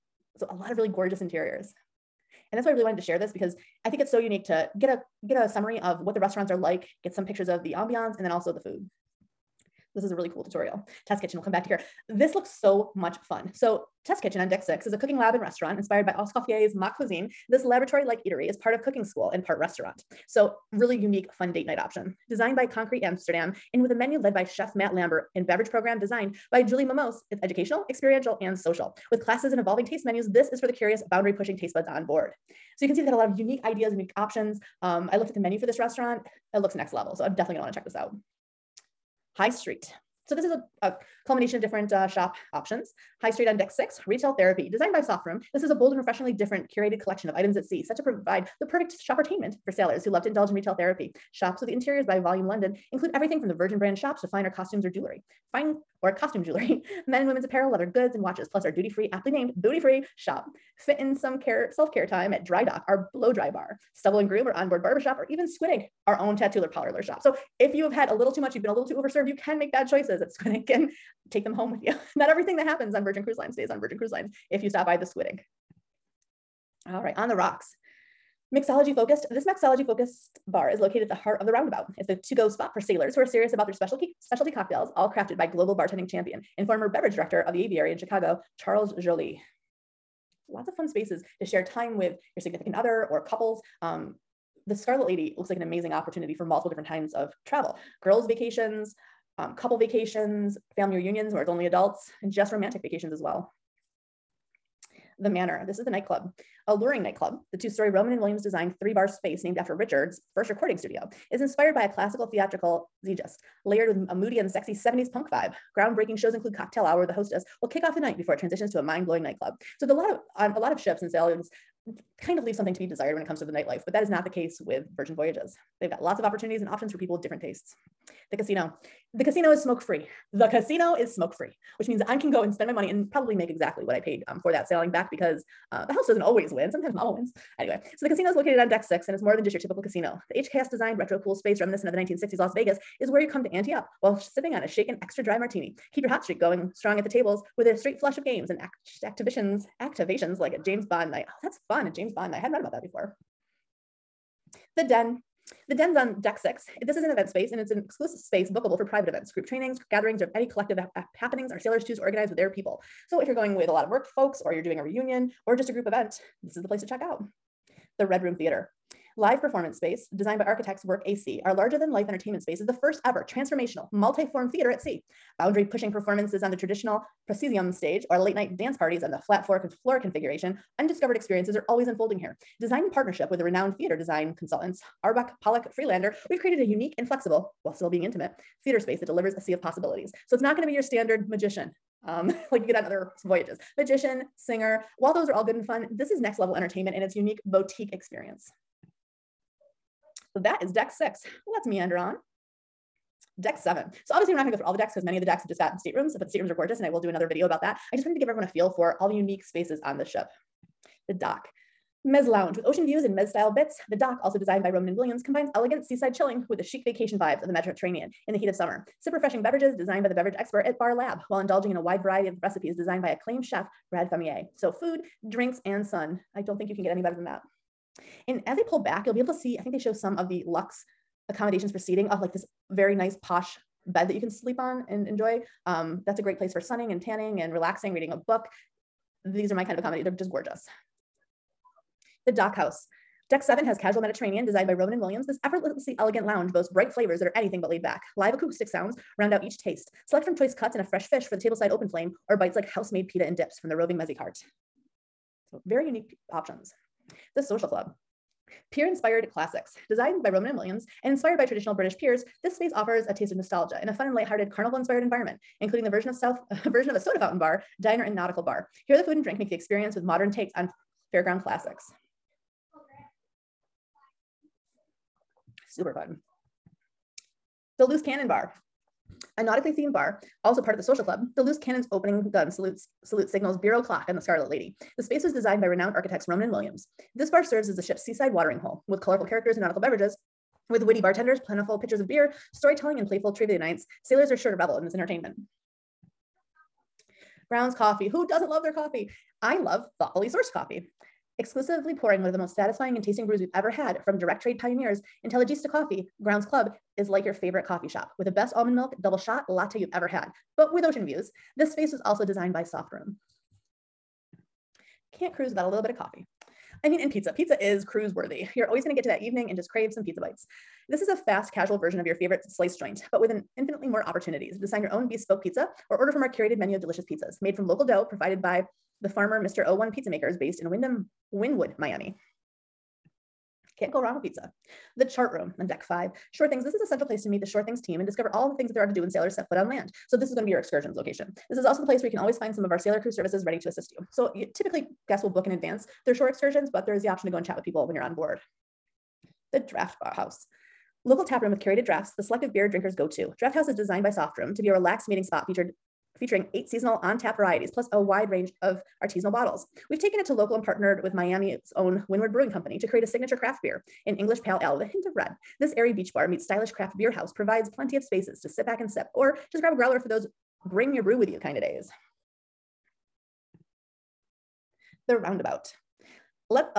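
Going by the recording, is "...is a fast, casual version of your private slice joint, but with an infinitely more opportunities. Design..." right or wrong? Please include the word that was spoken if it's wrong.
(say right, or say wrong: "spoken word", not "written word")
wrong: "favorite", not "private".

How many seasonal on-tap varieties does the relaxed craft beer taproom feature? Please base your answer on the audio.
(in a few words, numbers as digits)
8.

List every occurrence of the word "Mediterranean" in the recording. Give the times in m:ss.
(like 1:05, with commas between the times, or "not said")
3:37, 4:03.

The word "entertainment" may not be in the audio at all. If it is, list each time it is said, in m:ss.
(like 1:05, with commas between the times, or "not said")
2:52, 3:16, 4:54.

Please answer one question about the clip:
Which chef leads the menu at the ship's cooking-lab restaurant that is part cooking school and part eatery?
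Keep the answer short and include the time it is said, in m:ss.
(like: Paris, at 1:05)
Matt Lambert, at 0:24.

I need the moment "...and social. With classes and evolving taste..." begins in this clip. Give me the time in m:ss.
0:28.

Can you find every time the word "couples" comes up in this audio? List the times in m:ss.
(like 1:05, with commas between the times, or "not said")
1:33, 1:39.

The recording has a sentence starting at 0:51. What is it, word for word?
Shops with the Interiors by Volume London include everything from the Virgin brand shops to finer costumes or jewelry.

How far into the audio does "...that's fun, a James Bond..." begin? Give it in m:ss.
2:31.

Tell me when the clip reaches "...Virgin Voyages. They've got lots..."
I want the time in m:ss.
2:04.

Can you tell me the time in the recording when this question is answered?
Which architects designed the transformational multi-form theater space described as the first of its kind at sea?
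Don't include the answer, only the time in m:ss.
2:50.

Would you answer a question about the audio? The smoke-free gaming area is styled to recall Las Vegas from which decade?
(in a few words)
1960s.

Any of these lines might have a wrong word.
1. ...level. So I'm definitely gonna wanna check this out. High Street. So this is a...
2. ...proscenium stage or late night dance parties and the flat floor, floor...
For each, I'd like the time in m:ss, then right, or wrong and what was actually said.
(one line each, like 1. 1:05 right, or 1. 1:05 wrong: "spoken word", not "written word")
1. 0:36 right
2. 2:57 right.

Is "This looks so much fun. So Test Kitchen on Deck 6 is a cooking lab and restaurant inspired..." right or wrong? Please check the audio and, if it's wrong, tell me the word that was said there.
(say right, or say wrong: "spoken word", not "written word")
right.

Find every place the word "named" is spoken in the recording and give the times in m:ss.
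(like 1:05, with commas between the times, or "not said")
0:59, 1:49.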